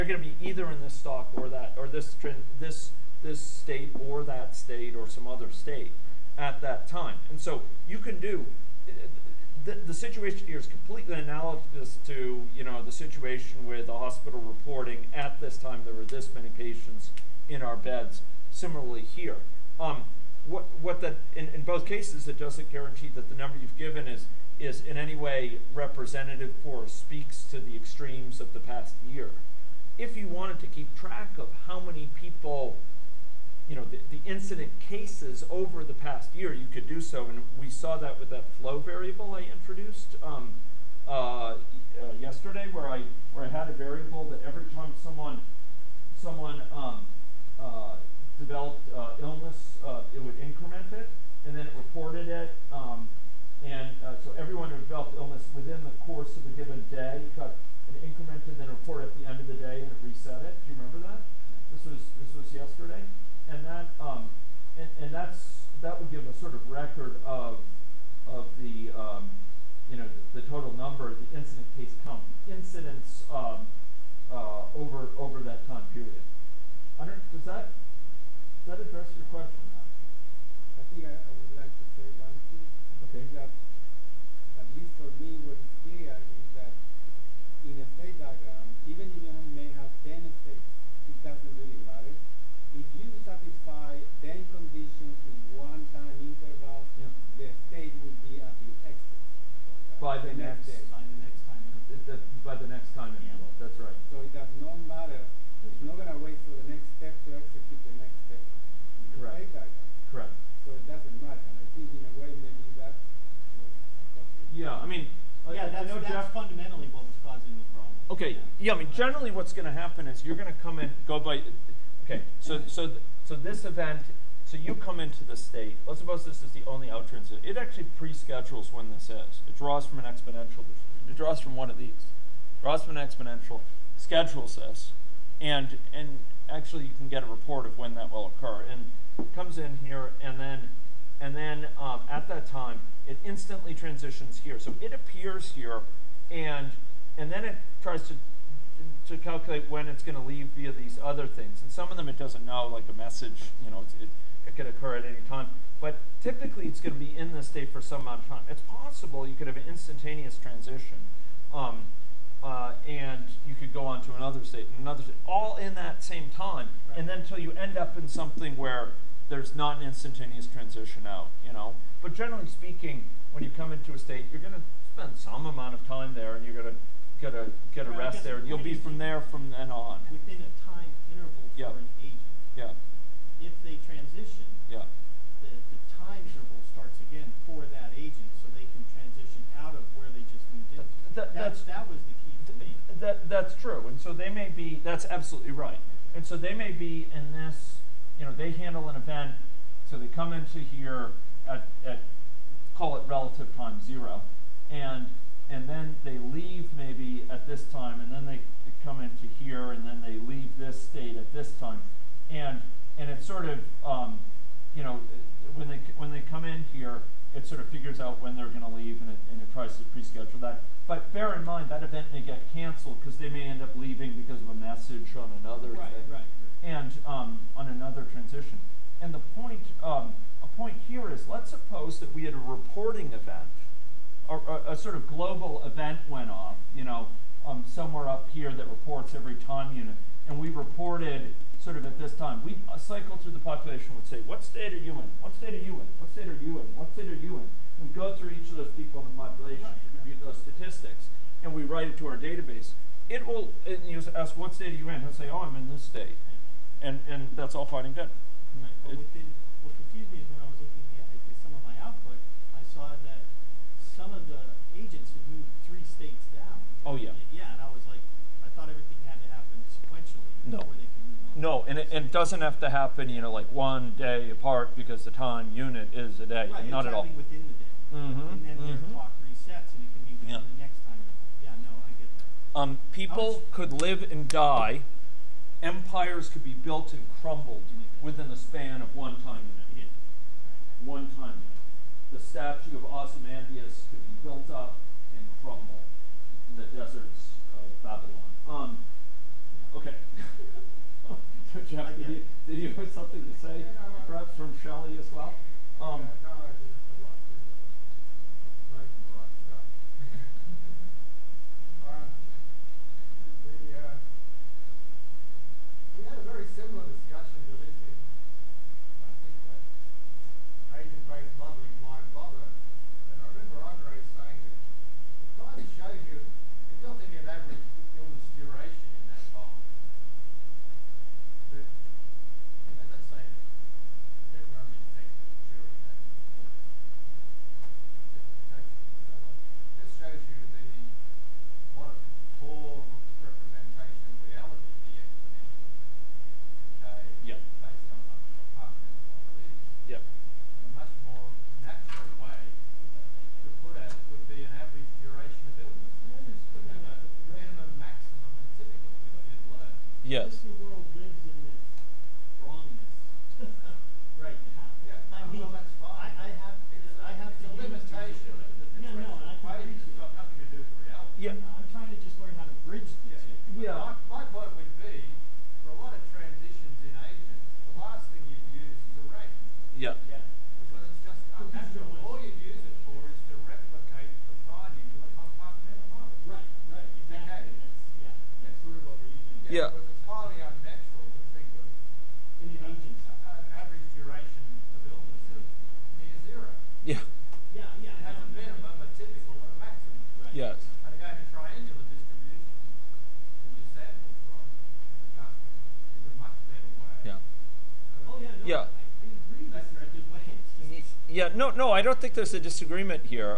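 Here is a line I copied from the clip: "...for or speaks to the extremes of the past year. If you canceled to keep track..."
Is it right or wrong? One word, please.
wrong.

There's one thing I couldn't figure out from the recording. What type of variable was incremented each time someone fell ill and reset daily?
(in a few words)
flow variable.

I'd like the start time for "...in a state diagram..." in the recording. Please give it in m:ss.
1:27.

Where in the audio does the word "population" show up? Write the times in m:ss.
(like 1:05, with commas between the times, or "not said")
4:03, 4:09.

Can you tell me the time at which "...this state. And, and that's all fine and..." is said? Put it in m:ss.
4:15.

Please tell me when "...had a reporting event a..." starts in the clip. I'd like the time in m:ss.
3:52.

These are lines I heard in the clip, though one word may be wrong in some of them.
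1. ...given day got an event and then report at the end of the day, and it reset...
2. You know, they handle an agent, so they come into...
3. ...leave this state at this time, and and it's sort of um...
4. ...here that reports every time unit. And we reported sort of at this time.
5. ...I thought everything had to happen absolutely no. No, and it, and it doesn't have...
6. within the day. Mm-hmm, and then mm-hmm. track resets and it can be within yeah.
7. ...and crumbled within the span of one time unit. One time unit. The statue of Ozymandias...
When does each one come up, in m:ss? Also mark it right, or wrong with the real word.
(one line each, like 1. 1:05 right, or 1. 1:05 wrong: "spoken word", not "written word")
1. 0:56 wrong: "increment", not "event"
2. 3:18 wrong: "event", not "agent"
3. 3:30 right
4. 3:58 right
5. 4:28 wrong: "sequentially", not "absolutely"
6. 4:37 wrong: "clock", not "track"
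7. 4:46 right.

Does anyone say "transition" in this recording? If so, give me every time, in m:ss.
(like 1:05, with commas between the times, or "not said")
2:07, 2:23, 2:40, 2:50, 3:03, 3:08, 3:48.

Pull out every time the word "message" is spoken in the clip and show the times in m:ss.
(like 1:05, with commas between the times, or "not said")
2:32, 3:44.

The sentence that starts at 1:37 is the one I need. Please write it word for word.
the state will be at the exit.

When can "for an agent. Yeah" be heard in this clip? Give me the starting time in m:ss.
3:01.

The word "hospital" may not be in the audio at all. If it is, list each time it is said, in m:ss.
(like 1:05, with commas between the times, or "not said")
0:13.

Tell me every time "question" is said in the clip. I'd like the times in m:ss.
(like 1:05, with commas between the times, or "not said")
1:19.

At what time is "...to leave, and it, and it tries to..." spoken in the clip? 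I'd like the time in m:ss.
3:38.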